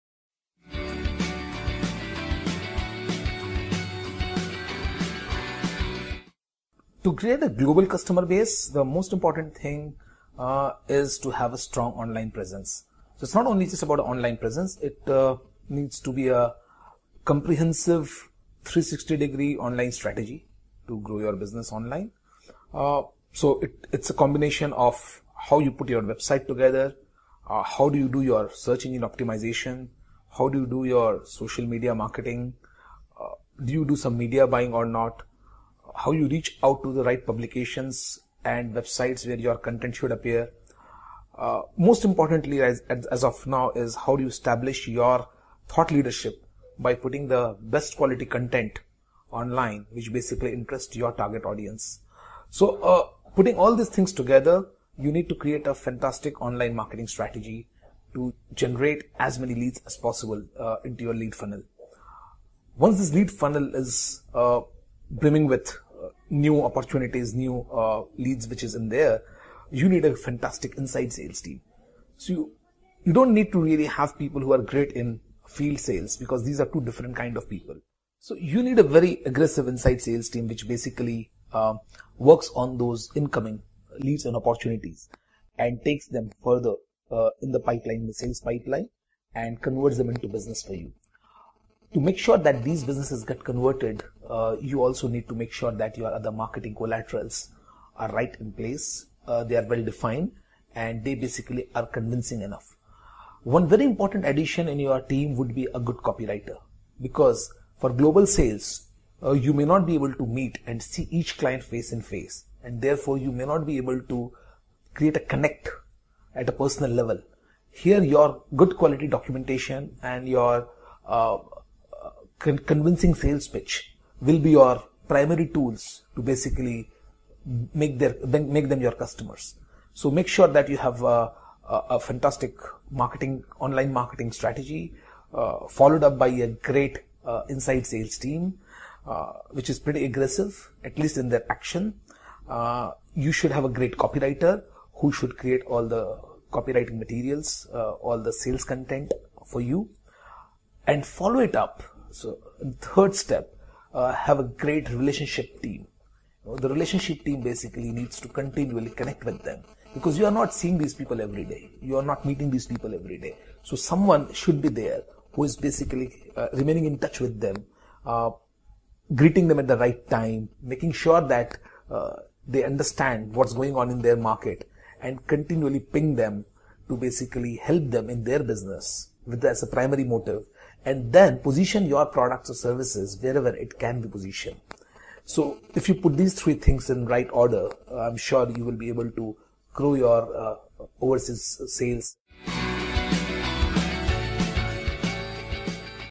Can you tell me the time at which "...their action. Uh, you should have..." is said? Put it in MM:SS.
02:21.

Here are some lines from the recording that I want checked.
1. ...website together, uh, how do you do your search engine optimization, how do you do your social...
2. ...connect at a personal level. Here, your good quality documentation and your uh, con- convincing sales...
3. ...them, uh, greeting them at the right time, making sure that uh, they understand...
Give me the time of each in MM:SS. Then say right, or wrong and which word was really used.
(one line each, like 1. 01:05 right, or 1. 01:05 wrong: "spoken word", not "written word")
1. 00:26 right
2. 01:55 right
3. 02:47 right.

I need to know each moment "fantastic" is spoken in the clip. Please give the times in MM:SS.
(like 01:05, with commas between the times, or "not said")
00:55, 01:10, 02:11.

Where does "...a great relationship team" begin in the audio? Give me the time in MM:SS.
02:34.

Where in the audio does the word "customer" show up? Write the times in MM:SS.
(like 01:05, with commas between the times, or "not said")
00:07, 02:08.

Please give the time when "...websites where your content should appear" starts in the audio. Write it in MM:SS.
00:38.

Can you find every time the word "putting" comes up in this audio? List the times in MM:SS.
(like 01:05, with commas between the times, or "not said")
00:46, 00:53.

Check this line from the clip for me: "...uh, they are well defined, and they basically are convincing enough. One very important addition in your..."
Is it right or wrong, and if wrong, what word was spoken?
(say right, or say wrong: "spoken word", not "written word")
right.